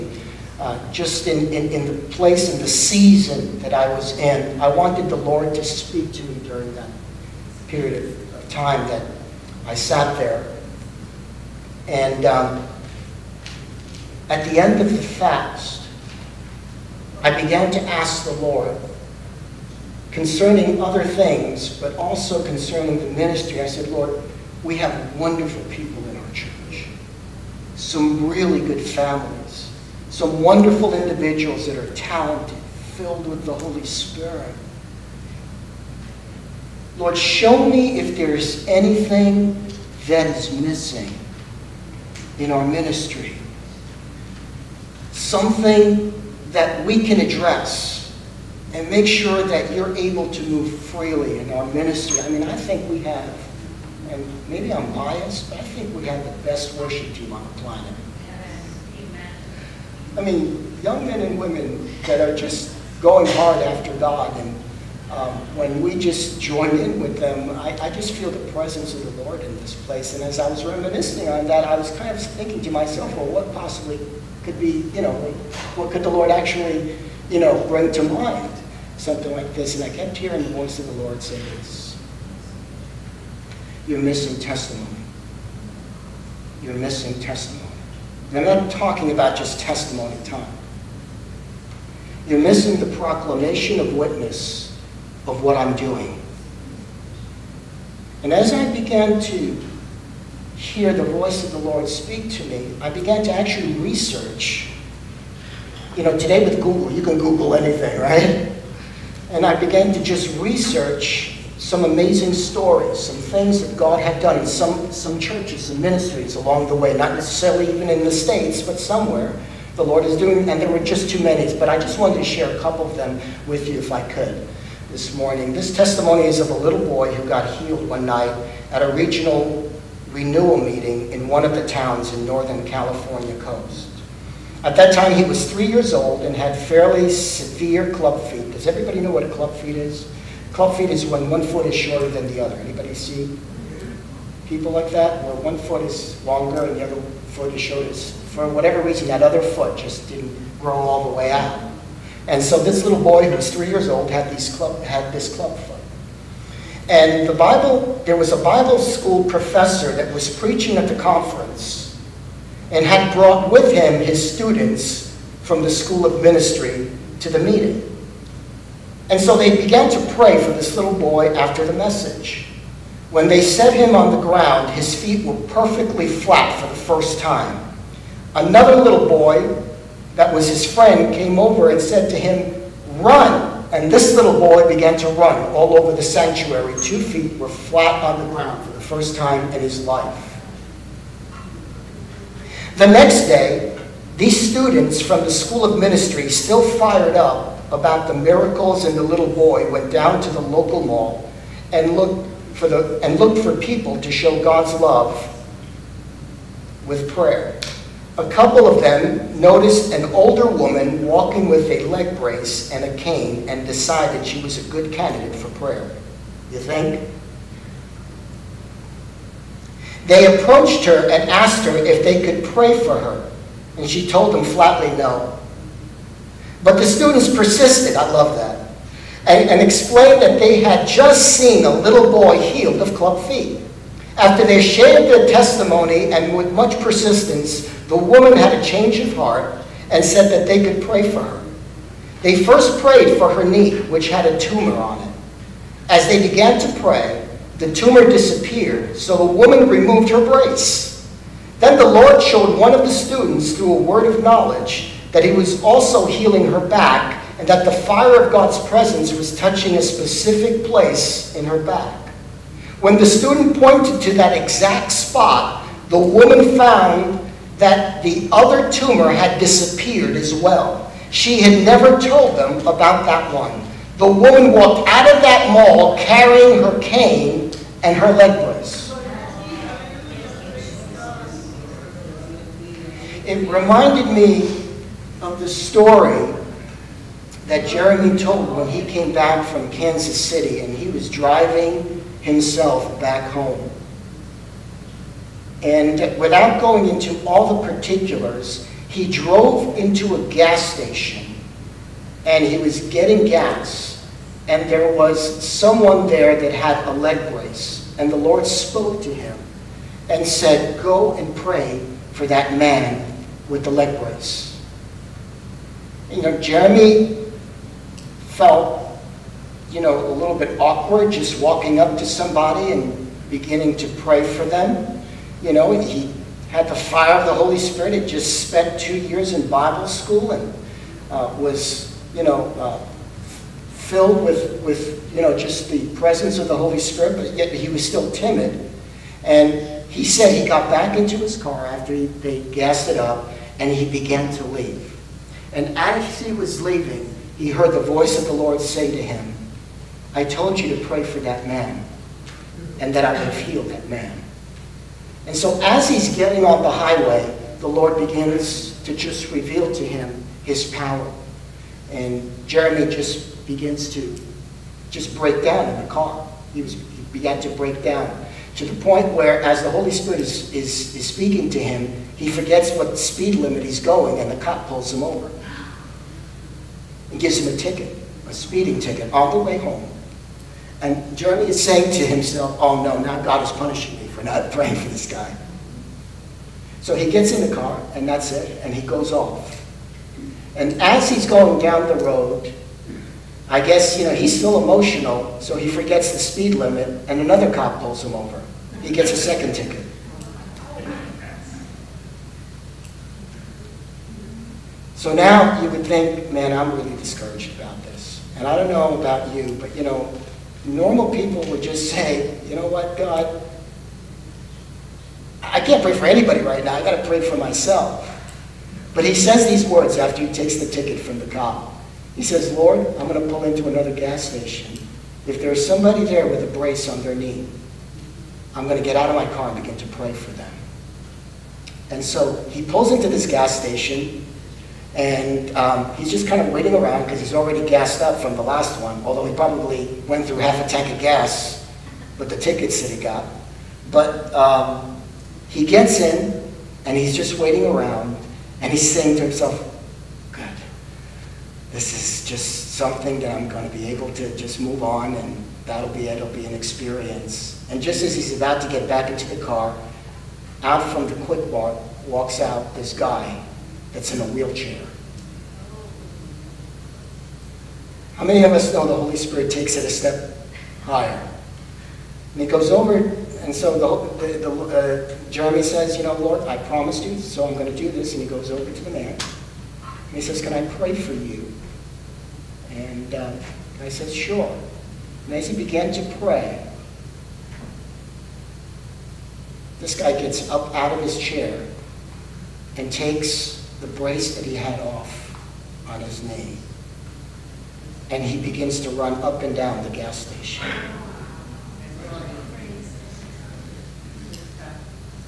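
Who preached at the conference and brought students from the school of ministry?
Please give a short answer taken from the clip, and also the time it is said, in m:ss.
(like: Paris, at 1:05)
A Bible school professor, at 2:38.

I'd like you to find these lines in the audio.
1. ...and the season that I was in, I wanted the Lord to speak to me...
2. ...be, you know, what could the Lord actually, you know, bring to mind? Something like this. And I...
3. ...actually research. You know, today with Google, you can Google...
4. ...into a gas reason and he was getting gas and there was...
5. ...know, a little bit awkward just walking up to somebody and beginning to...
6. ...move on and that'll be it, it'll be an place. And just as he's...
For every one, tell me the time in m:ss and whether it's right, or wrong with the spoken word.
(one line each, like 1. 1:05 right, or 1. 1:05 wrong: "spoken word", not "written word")
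1. 0:02 right
2. 1:14 right
3. 1:43 right
4. 4:59 wrong: "station", not "reason"
5. 5:19 right
6. 7:34 wrong: "experience", not "place".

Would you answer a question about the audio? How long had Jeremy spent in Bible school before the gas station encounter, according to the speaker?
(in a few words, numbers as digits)
2 years.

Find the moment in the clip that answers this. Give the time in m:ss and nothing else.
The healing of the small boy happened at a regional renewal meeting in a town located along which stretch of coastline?
2:12.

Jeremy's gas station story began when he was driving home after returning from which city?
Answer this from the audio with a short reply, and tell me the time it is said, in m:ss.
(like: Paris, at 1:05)
Kansas City, at 4:49.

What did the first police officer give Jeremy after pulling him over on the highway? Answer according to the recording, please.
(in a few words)
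A speeding ticket.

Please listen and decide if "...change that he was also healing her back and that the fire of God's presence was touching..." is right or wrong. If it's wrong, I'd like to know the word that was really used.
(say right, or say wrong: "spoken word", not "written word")
wrong: "knowledge", not "change".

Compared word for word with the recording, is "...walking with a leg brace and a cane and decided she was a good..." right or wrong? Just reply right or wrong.
right.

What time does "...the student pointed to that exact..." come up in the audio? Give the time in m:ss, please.
4:22.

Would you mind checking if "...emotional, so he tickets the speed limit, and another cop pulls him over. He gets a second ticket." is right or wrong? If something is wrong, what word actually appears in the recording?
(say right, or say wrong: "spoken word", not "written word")
wrong: "forgets", not "tickets".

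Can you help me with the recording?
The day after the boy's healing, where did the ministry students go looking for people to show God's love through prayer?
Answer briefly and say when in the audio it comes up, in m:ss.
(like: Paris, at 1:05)
The local mall, at 3:20.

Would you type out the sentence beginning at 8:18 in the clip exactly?
And he begins to run up and down the gas station.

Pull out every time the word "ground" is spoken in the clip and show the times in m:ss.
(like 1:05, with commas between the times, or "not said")
2:54, 3:08.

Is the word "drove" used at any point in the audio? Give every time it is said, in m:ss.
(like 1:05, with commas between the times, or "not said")
4:59.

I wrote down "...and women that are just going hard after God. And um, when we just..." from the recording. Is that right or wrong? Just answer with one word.
right.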